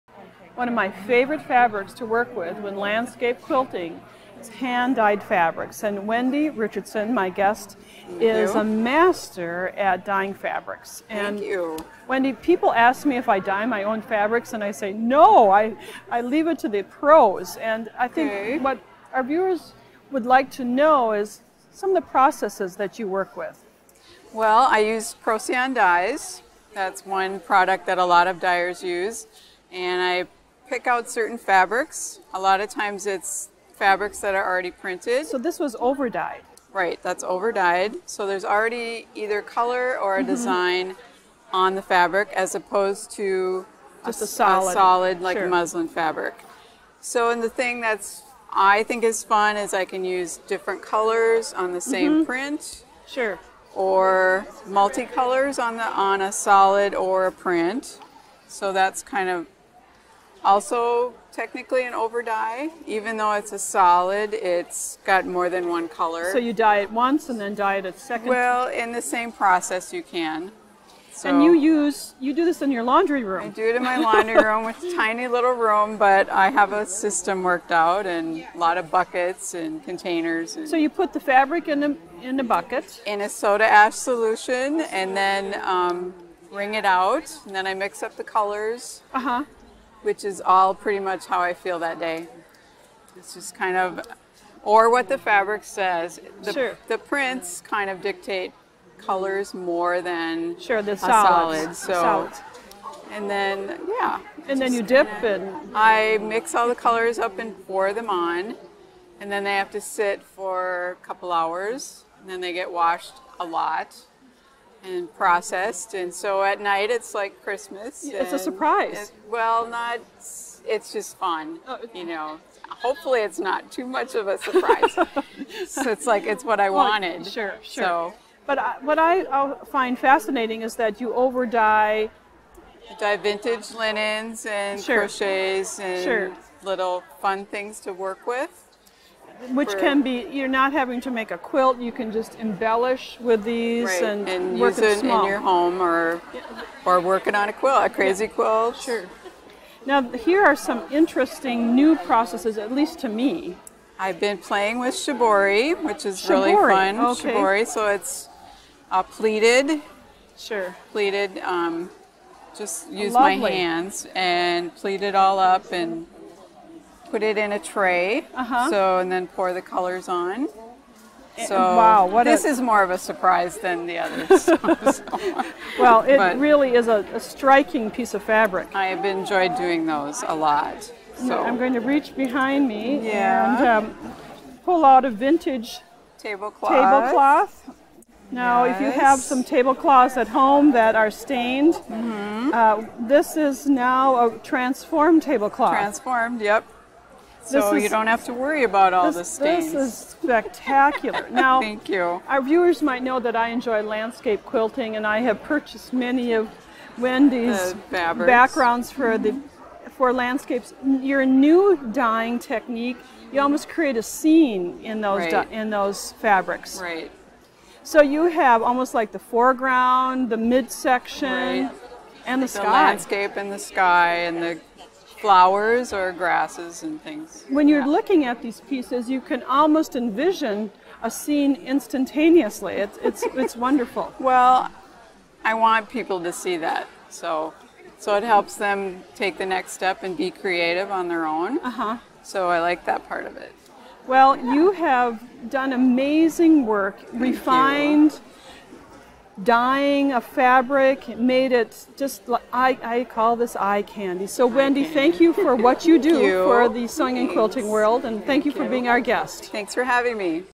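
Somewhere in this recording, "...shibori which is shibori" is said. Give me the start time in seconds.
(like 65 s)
154 s.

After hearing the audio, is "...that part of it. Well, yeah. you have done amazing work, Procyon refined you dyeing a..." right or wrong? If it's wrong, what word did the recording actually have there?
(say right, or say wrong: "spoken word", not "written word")
wrong: "Thank", not "Procyon".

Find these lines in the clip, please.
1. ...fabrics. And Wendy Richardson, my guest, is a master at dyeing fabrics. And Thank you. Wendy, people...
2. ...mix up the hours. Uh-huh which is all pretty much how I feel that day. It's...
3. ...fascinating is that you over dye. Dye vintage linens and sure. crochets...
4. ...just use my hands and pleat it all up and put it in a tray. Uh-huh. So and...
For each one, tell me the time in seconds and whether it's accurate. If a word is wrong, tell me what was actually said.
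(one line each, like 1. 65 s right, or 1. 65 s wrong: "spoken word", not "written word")
1. 5 s right
2. 87 s wrong: "colors", not "hours"
3. 129 s right
4. 162 s right.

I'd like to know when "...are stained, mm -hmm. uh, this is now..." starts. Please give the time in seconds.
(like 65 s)
190 s.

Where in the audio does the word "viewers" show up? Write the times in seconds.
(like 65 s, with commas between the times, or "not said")
19 s, 202 s.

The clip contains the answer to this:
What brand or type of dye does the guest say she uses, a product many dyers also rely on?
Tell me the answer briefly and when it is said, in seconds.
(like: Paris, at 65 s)
Procyon dyes, at 25 s.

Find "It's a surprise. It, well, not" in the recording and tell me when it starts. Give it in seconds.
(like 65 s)
118 s.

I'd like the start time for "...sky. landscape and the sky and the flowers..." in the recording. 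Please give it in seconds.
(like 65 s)
222 s.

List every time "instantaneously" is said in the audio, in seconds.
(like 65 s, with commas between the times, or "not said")
231 s.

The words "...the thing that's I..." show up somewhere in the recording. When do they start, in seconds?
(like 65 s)
47 s.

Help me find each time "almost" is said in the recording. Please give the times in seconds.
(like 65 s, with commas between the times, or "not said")
213 s, 218 s, 229 s.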